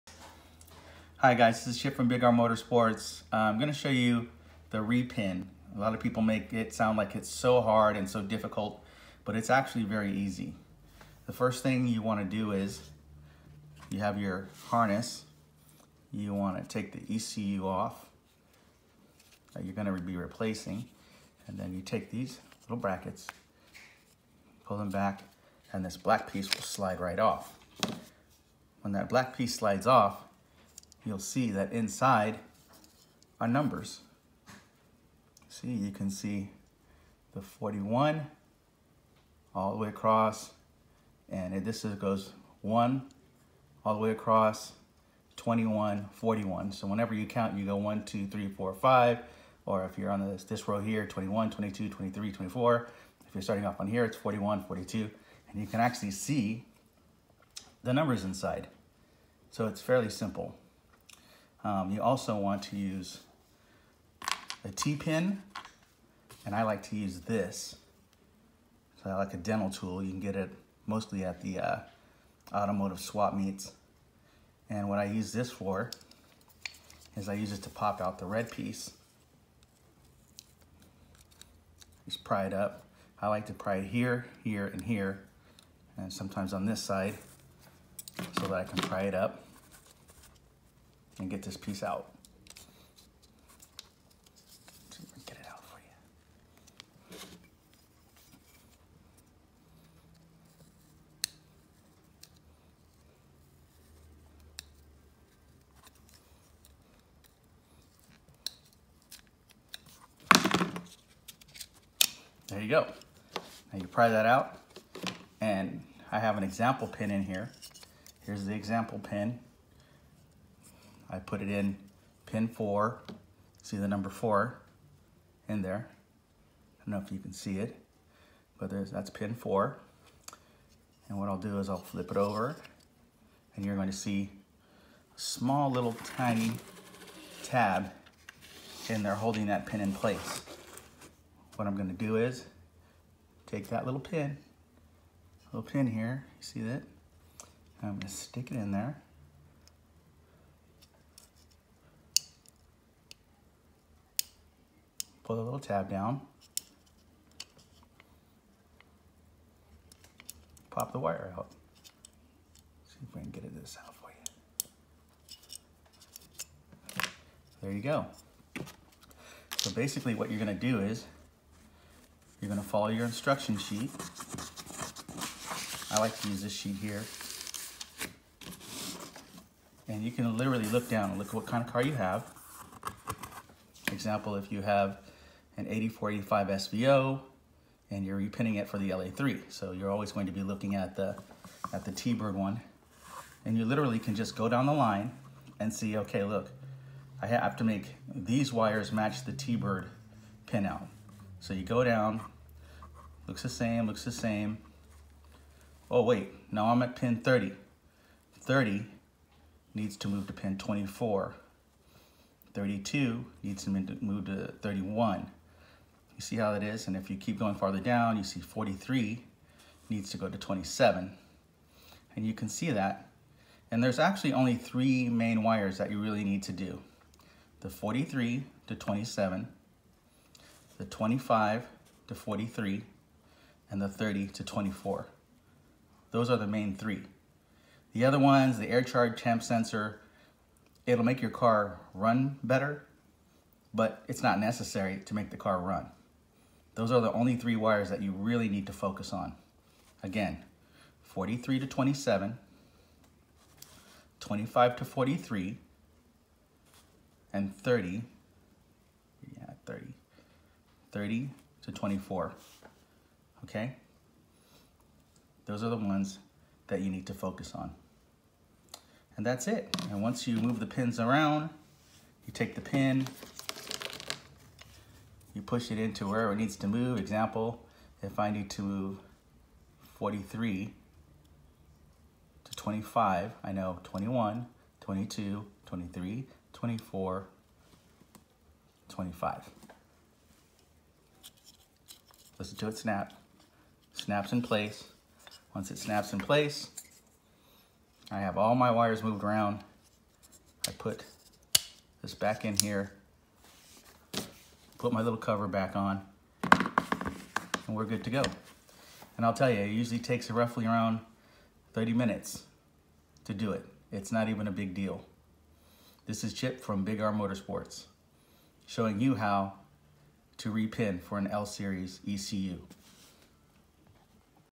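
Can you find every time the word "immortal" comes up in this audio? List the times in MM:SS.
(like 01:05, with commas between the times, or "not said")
not said.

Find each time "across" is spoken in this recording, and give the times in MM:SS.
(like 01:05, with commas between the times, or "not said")
00:39, 00:44.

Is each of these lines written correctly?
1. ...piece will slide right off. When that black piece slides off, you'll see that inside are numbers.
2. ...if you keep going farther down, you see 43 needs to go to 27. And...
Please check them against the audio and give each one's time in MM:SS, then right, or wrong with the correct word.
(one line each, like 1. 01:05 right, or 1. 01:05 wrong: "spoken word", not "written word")
1. 00:26 right
2. 03:36 right.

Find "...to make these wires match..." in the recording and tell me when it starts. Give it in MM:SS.
03:17.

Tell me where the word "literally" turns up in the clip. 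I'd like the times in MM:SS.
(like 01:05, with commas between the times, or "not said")
03:00, 03:13.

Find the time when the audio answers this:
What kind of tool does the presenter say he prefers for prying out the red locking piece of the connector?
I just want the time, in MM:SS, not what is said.
01:09.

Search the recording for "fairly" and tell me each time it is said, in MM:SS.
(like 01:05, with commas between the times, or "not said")
00:59.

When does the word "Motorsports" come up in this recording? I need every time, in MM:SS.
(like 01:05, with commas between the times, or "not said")
00:02, 05:17.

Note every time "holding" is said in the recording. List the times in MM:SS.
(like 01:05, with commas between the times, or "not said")
02:19.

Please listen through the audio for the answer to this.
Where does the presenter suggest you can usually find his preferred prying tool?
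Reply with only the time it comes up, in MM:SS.
01:12.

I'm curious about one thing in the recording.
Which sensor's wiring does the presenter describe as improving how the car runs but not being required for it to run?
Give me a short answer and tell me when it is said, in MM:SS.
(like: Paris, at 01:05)
Air charge temp sensor, at 03:58.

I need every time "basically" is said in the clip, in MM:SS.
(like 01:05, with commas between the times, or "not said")
02:49.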